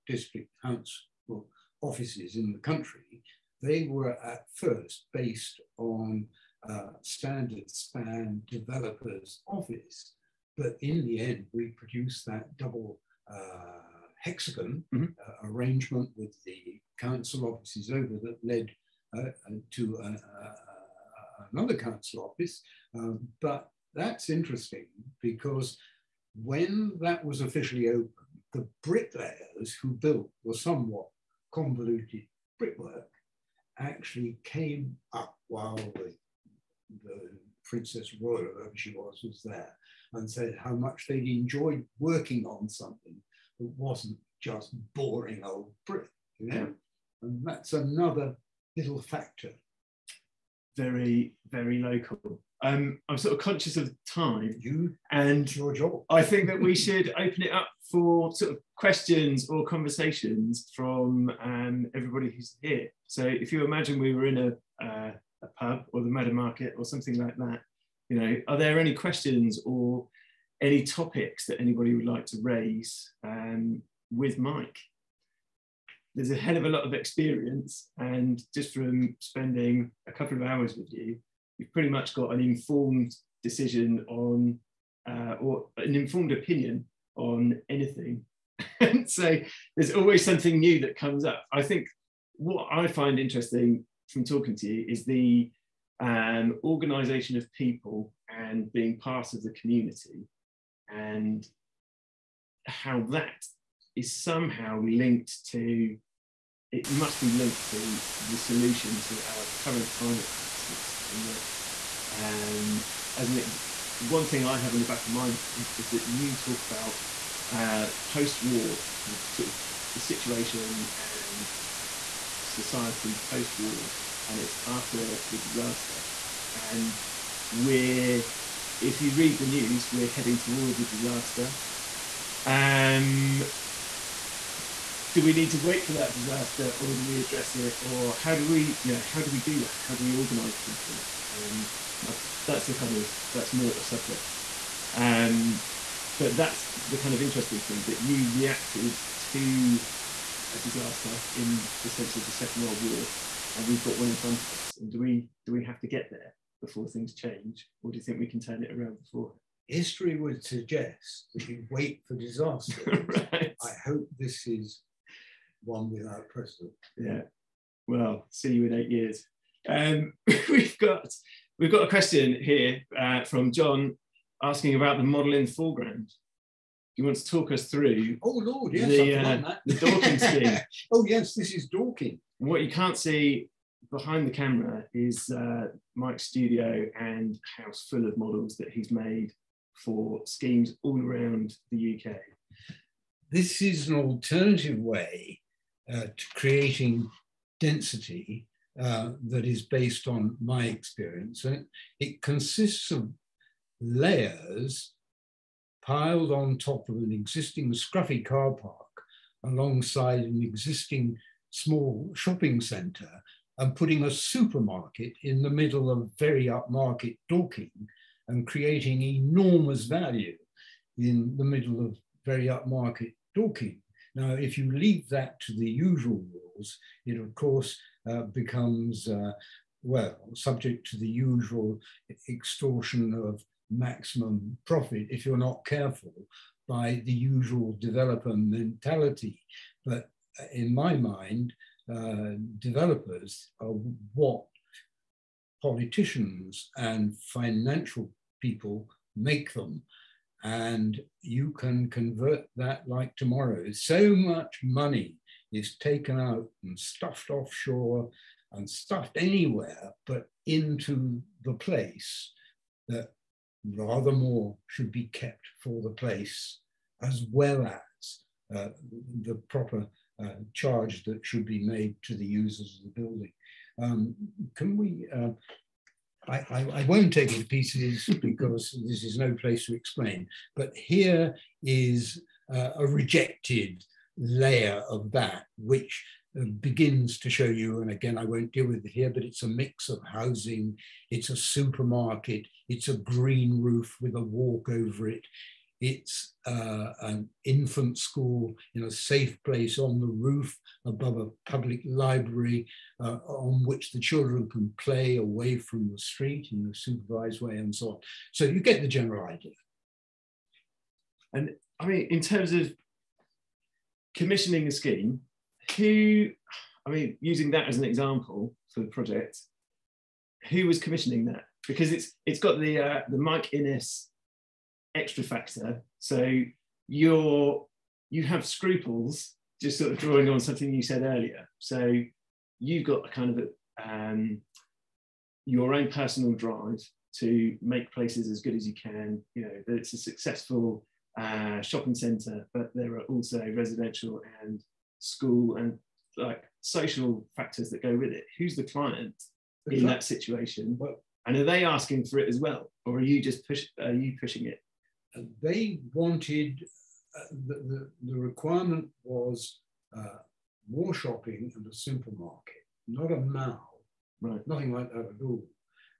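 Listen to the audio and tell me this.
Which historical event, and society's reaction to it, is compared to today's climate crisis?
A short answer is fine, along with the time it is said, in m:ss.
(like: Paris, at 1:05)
Second World War, at 2:32.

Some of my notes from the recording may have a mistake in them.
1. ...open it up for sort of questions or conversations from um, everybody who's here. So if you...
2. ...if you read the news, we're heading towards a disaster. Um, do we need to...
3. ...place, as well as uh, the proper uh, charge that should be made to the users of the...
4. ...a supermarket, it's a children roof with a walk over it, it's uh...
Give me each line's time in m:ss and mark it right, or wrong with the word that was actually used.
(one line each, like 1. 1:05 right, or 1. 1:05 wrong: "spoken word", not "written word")
1. 0:57 right
2. 2:08 right
3. 4:25 right
4. 4:51 wrong: "green", not "children".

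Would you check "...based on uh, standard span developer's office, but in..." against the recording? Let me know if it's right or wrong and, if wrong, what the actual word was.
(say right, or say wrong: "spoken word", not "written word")
right.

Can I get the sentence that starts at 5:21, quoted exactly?
Because it's it's got the uh, the Mike Innes extra factor.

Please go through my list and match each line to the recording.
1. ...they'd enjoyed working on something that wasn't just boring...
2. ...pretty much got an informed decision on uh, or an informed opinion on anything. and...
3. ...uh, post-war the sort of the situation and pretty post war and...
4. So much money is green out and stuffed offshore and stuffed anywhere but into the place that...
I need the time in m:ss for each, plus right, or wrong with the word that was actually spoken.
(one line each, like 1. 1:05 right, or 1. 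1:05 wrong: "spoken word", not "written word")
1. 0:41 right
2. 1:21 right
3. 1:57 wrong: "society", not "pretty"
4. 4:13 wrong: "taken", not "green".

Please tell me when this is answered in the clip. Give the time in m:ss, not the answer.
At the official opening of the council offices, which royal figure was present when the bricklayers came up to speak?
0:37.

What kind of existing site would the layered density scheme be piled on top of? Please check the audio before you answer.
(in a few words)
scruffy car park.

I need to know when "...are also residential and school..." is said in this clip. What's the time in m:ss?
5:42.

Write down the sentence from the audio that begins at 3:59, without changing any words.
But in my mind, uh, developers are what politicians and financial people make them.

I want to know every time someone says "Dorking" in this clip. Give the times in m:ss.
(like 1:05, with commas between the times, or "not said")
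3:01, 3:37, 3:43.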